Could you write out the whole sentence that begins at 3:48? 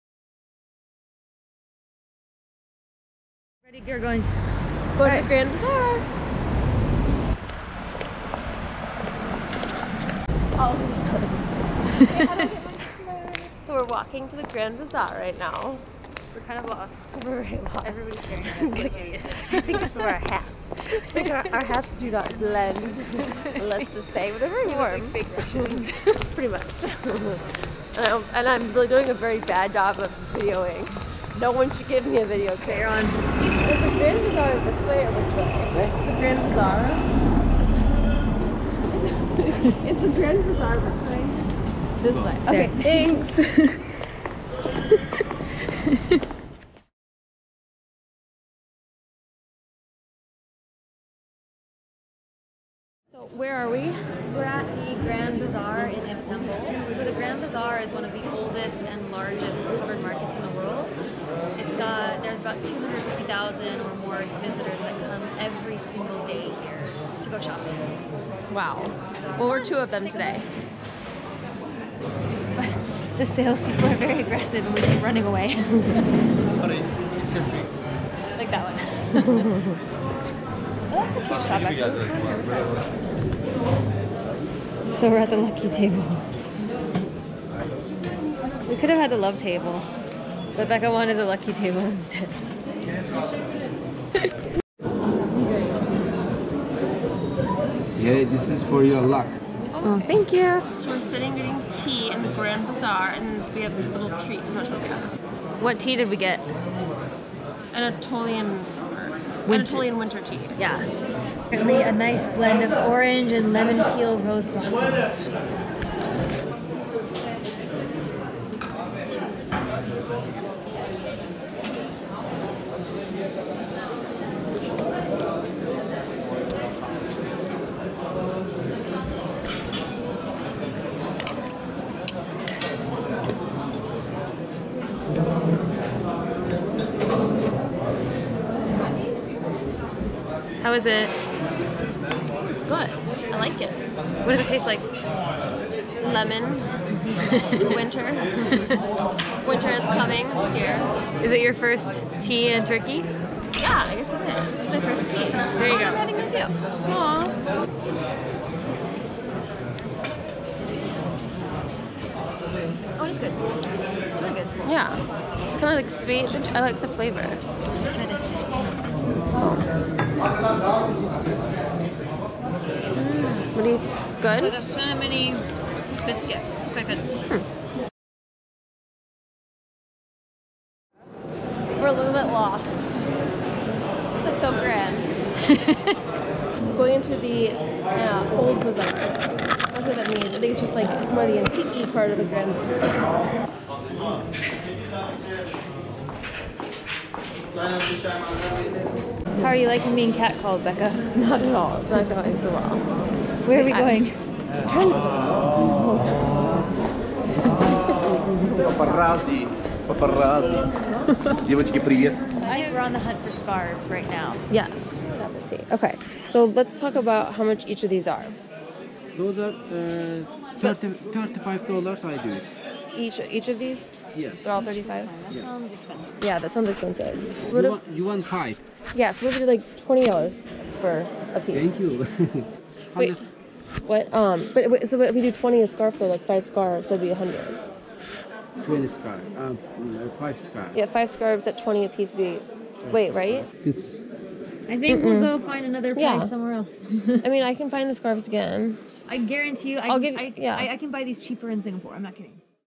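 Yes, we'll do like $20 for a piece.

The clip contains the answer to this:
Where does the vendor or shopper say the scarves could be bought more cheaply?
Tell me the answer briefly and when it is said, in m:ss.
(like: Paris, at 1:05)
Singapore, at 4:11.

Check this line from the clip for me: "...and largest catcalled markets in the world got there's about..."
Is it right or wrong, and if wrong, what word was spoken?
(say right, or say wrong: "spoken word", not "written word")
wrong: "covered", not "catcalled".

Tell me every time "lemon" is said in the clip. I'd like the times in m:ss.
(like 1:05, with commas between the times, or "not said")
1:53, 2:26.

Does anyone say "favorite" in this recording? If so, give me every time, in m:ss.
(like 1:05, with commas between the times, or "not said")
not said.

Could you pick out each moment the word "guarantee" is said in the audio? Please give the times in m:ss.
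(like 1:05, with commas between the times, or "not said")
4:09.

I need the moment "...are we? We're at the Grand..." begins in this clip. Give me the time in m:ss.
0:53.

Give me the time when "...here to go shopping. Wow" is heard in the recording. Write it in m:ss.
1:06.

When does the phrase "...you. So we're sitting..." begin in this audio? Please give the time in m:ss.
1:40.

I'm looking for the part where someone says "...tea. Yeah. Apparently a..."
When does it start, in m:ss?
1:50.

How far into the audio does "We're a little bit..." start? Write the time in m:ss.
3:01.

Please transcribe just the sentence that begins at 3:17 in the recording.
How are you liking being catcalled, Becca?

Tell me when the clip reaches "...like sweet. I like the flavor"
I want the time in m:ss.
2:45.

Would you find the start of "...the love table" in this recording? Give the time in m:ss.
1:29.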